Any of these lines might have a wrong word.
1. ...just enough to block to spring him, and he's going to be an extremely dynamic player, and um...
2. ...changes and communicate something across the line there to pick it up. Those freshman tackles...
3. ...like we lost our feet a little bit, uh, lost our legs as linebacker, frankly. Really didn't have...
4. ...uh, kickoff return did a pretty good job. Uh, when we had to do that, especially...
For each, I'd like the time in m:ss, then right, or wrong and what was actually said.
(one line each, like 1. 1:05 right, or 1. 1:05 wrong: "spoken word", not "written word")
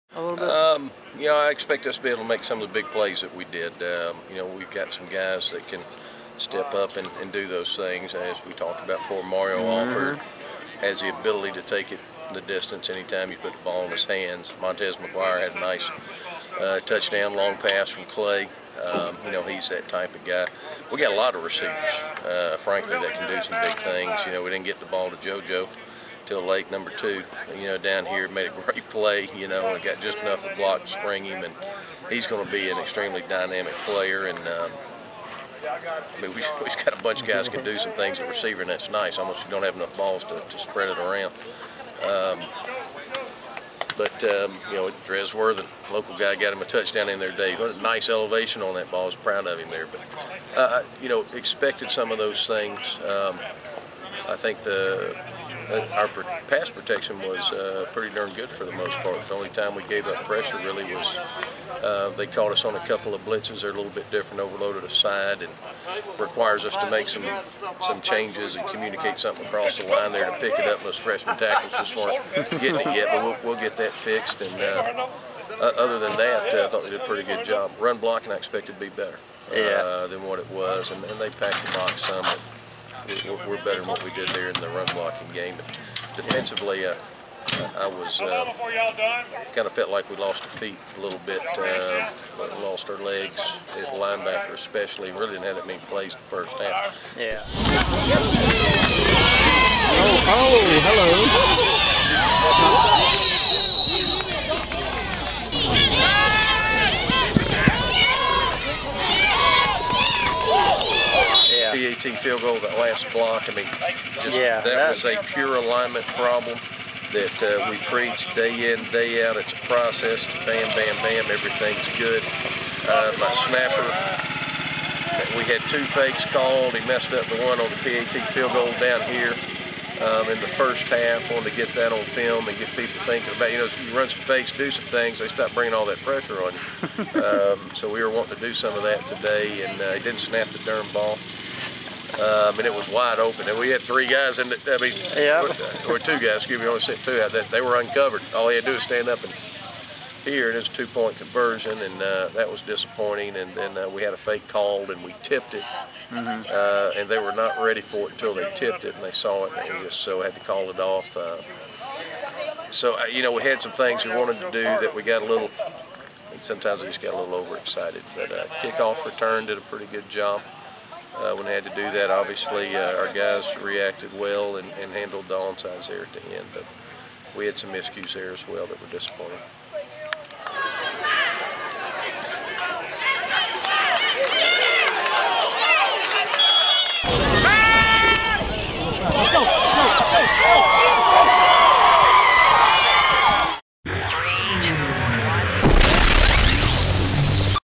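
1. 0:30 right
2. 1:08 right
3. 1:29 wrong: "especially", not "frankly"
4. 2:48 wrong: "obviously", not "especially".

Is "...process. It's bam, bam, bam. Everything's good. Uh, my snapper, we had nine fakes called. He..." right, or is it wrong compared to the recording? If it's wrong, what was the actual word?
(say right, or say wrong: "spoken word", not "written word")
wrong: "two", not "nine".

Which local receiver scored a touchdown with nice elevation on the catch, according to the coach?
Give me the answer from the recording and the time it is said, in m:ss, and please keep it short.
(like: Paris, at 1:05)
Drez Worthen, at 0:45.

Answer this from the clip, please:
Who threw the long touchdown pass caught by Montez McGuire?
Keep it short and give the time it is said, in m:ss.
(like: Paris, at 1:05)
Clay, at 0:18.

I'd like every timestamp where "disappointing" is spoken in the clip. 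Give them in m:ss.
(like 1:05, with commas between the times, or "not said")
2:32, 2:58.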